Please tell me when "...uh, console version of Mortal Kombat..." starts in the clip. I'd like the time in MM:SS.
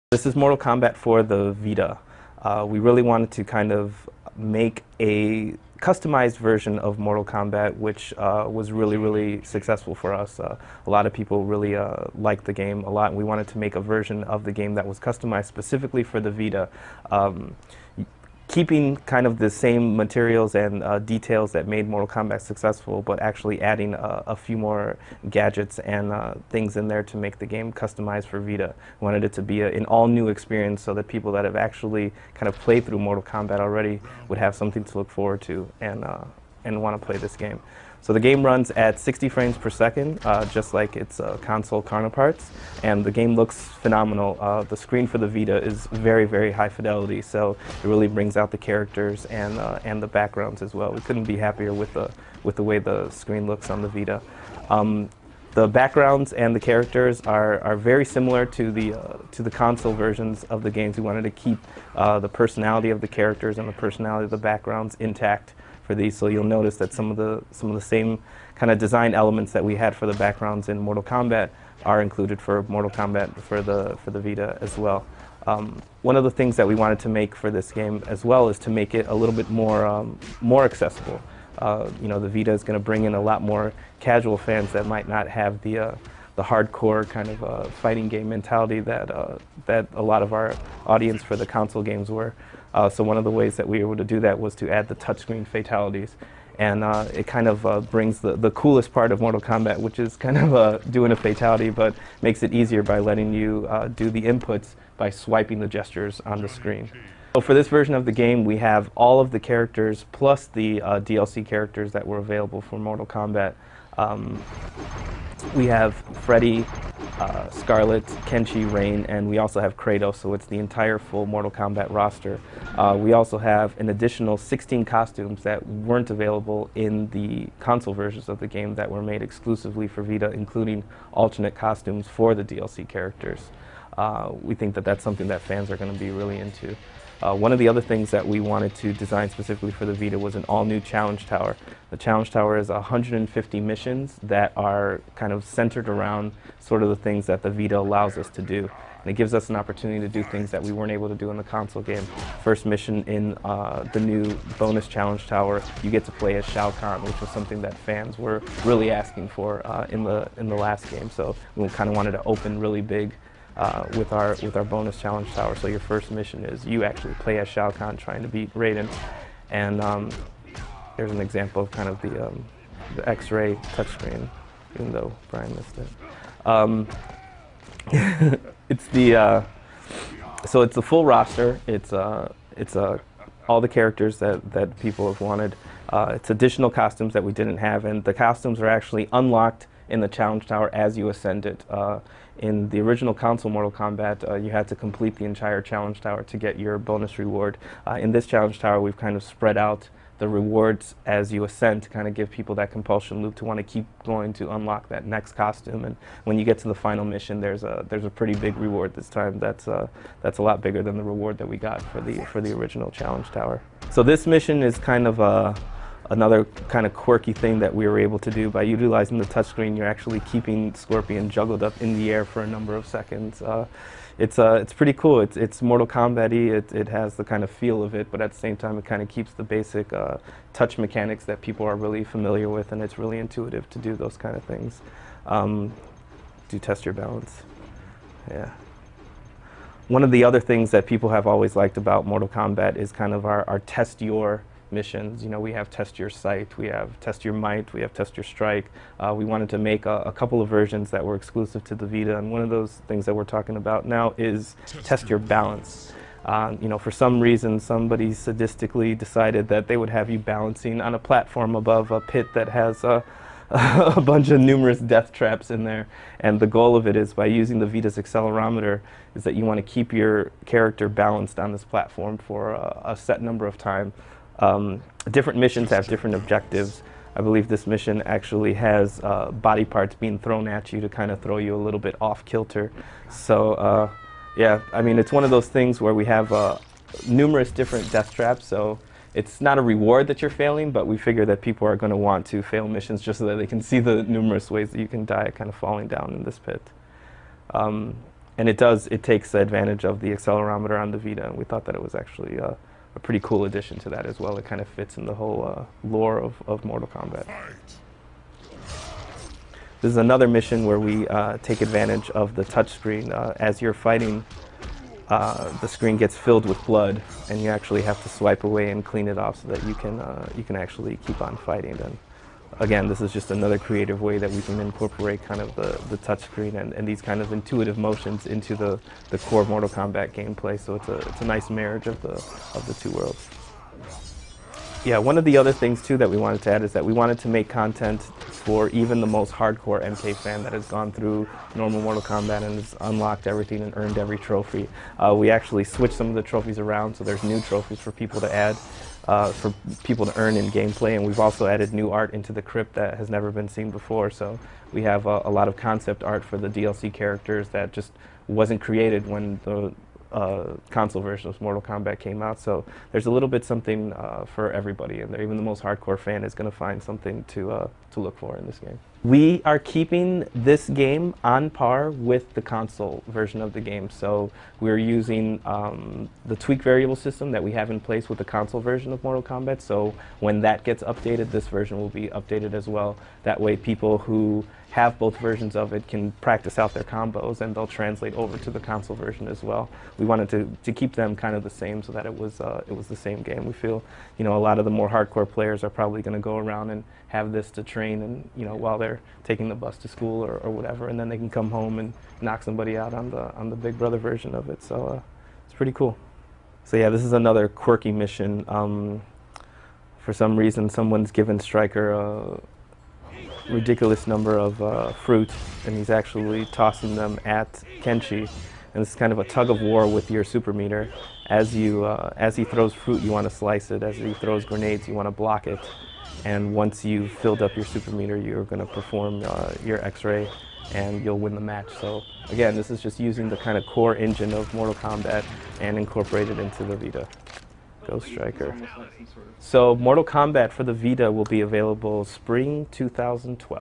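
06:00.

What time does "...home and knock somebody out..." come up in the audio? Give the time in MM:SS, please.
06:41.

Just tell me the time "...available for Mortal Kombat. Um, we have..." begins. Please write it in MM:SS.
01:52.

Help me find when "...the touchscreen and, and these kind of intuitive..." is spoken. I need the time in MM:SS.
05:25.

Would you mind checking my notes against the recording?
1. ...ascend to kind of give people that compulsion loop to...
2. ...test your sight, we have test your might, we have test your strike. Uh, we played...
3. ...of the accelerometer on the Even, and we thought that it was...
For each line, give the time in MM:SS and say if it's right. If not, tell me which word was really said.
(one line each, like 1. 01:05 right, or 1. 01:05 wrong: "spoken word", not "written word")
1. 03:21 right
2. 04:05 wrong: "wanted", not "played"
3. 04:59 wrong: "Vita", not "Even".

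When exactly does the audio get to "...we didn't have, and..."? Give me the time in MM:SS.
03:07.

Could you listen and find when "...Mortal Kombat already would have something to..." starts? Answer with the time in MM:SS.
00:32.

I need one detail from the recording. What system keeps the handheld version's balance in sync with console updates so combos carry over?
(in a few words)
tweak variable system.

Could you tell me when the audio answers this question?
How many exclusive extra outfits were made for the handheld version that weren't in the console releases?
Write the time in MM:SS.
02:04.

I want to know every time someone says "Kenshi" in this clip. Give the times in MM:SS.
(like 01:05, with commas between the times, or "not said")
01:58, 06:57.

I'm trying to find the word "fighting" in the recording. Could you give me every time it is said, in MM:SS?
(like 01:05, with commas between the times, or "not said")
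01:27, 05:13, 05:21.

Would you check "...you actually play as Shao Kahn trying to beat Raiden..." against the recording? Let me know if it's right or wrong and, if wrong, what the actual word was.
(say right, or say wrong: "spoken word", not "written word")
right.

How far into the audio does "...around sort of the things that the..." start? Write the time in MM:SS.
02:25.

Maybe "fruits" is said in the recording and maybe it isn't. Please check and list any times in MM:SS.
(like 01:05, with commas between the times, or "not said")
06:54, 07:02.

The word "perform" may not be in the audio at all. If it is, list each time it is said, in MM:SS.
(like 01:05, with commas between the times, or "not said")
07:08.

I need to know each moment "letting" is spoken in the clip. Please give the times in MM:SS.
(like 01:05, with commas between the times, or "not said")
01:42.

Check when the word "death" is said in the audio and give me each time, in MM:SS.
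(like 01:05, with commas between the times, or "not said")
04:24, 04:47.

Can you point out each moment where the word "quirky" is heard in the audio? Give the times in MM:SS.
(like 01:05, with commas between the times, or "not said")
03:36, 06:47.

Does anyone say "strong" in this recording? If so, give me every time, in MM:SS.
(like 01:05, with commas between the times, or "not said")
not said.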